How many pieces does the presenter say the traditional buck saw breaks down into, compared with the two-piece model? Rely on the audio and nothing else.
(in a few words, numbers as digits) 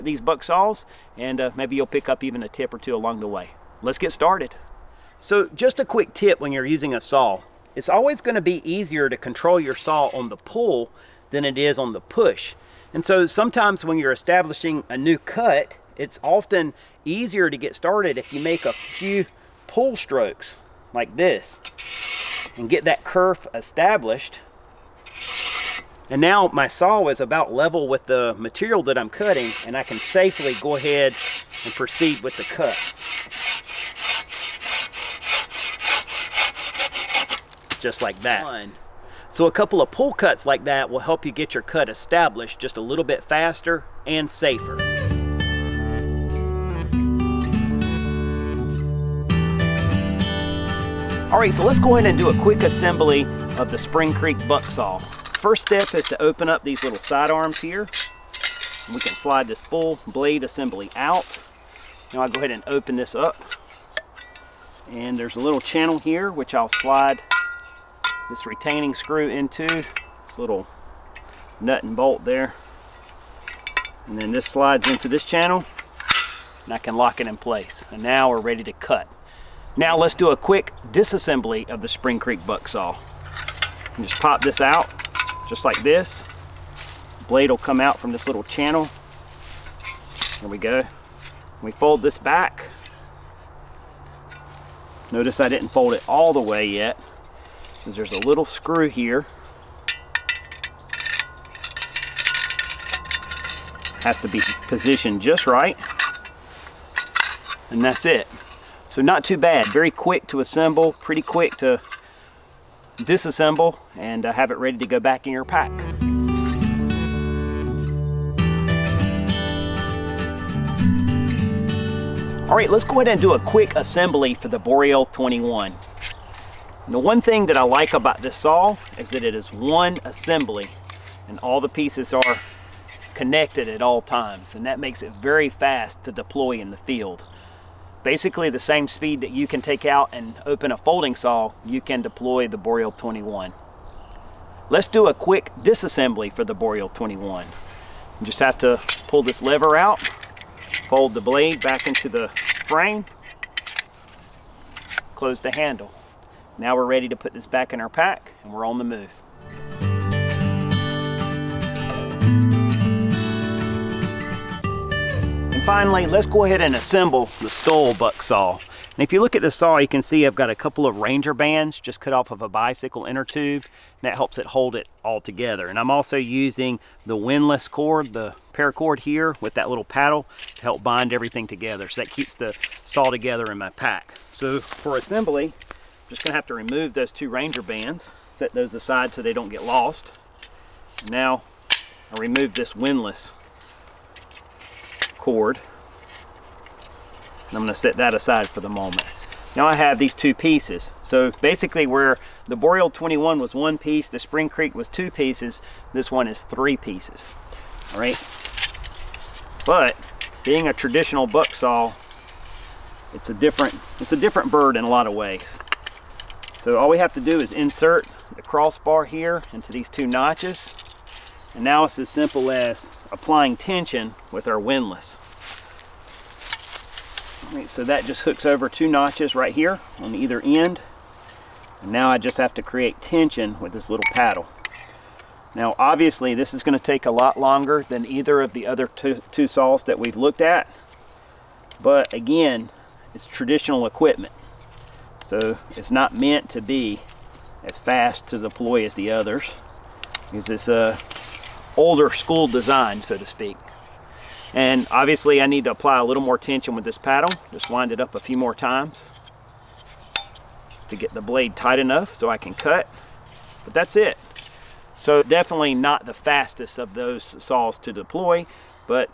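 3.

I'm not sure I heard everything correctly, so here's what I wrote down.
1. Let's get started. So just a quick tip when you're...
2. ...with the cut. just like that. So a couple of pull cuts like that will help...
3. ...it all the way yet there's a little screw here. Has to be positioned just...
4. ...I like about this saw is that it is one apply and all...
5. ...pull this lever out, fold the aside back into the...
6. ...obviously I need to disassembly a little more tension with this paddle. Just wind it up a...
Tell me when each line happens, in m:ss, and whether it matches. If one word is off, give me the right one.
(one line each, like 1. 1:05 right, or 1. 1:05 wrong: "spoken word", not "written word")
1. 0:03 right
2. 0:32 right
3. 1:35 right
4. 2:07 wrong: "assembly", not "apply"
5. 2:29 wrong: "blade", not "aside"
6. 4:14 wrong: "apply", not "disassembly".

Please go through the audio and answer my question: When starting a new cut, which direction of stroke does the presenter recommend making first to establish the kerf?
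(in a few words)
Pull strokes.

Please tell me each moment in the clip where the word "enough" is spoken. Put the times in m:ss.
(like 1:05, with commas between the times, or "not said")
4:21.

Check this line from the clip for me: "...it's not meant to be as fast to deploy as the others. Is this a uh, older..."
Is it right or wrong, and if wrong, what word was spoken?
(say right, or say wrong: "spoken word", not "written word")
right.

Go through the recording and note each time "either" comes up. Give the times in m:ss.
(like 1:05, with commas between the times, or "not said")
3:50, 3:58.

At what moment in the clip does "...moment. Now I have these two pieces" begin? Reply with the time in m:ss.
3:18.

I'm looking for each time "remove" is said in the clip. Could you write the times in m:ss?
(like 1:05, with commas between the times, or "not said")
3:06, 3:12.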